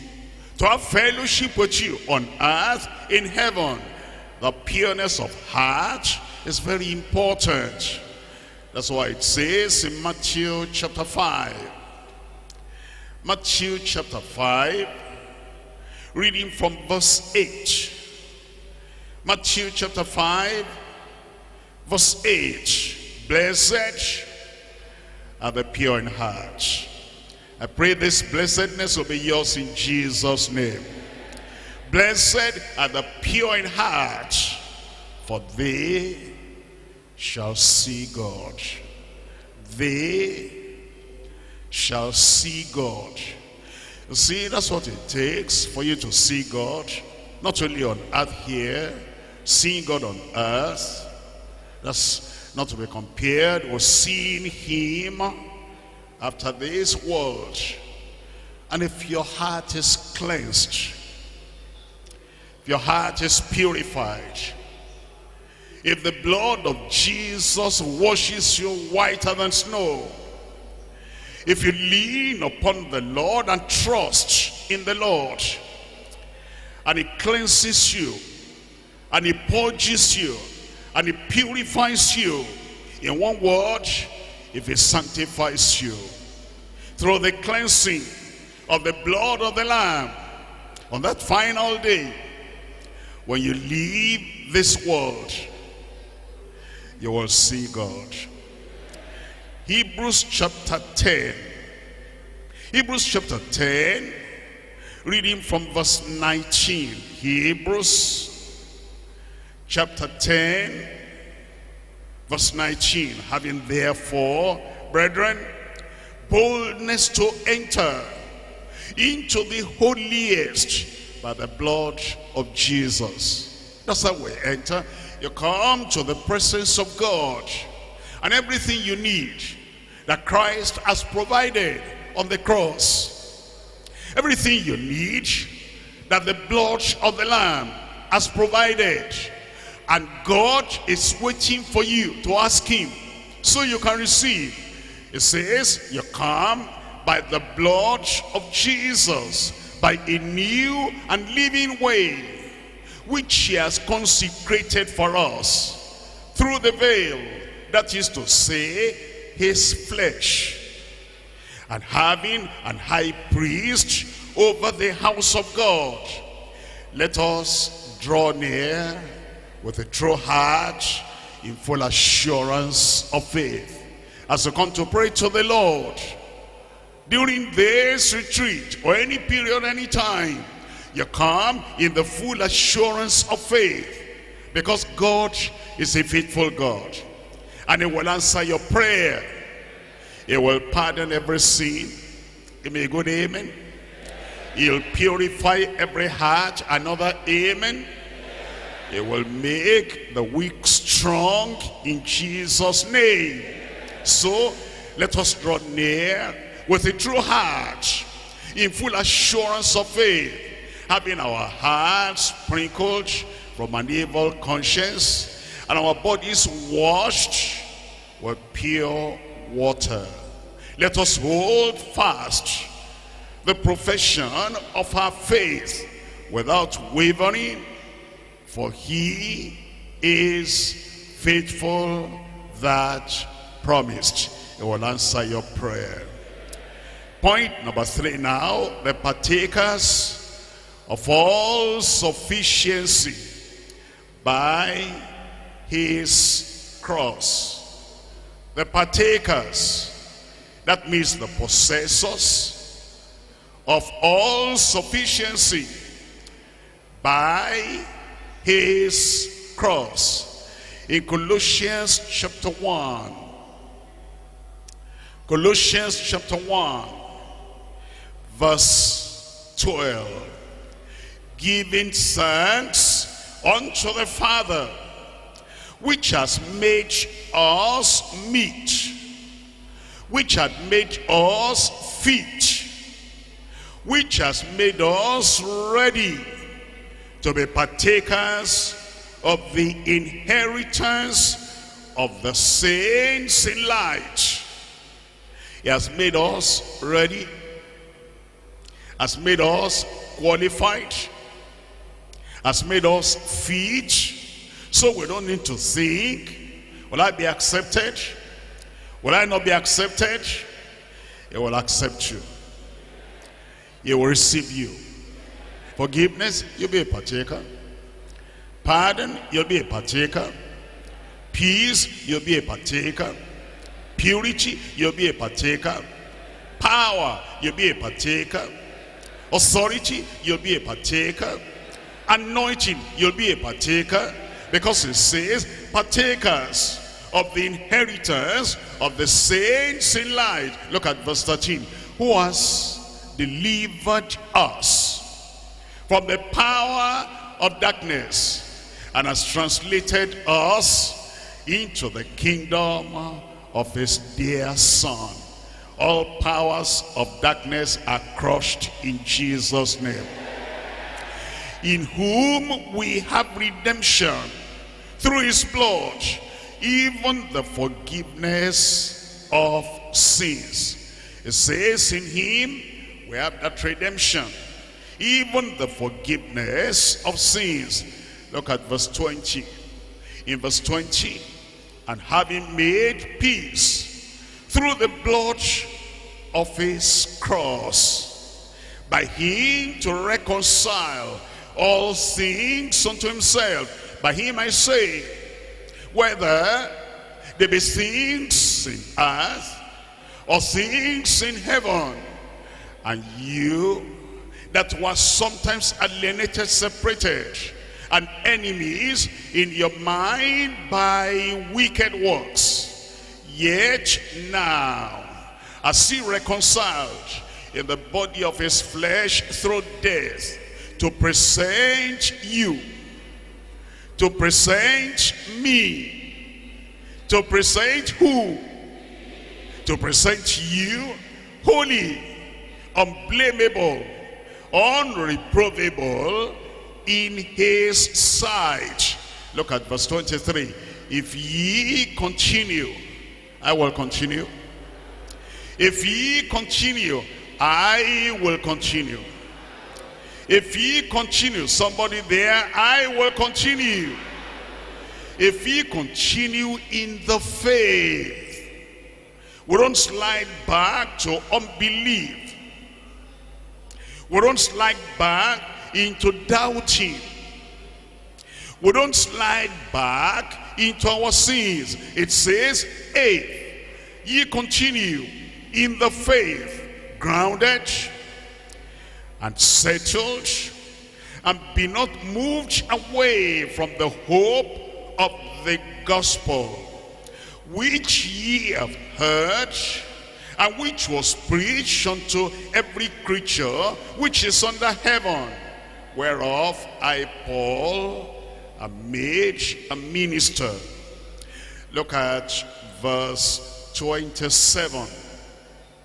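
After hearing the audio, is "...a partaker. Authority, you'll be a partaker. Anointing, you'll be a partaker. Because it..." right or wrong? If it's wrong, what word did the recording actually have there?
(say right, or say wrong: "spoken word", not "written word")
right.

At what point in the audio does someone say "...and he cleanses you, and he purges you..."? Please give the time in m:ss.
1:16.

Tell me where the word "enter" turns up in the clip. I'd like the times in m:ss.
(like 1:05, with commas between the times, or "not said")
1:57, 2:04.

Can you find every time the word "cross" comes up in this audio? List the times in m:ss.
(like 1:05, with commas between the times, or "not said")
2:12, 4:06, 4:19, 6:27.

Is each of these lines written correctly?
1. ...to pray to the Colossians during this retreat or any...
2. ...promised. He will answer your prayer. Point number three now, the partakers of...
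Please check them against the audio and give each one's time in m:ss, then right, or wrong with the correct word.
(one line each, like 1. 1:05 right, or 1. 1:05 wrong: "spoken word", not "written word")
1. 2:54 wrong: "Lord", not "Colossians"
2. 3:53 right.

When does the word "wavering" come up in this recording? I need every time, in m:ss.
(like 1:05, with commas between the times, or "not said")
3:46.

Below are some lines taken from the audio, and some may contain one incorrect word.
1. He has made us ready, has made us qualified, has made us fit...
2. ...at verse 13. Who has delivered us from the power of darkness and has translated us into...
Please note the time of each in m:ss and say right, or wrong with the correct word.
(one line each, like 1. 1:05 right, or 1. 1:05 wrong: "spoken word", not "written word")
1. 4:55 right
2. 5:40 right.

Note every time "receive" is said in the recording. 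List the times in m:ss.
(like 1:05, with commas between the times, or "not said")
2:23, 5:14.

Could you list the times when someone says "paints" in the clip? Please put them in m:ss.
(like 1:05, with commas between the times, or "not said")
not said.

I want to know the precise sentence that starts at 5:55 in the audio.
All powers of darkness are crushed in Jesus' name.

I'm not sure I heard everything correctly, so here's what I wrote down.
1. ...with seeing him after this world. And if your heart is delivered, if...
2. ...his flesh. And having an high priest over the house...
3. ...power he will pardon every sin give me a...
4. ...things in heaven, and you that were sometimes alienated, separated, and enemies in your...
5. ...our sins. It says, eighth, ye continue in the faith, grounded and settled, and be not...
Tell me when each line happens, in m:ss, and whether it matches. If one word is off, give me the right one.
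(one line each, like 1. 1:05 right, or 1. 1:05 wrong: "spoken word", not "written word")
1. 0:53 wrong: "cleansed", not "delivered"
2. 2:39 right
3. 3:08 wrong: "prayer", not "power"
4. 6:40 right
5. 7:50 right.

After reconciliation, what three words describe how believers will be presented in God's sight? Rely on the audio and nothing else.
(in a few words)
holy, unblameable, unreprovable.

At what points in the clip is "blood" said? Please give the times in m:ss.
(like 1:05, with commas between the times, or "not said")
1:06, 1:29, 2:01, 2:16, 2:27, 6:05, 6:25.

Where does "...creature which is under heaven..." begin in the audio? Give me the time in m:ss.
8:13.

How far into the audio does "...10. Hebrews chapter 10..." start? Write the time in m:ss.
1:40.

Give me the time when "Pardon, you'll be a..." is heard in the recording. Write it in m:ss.
5:18.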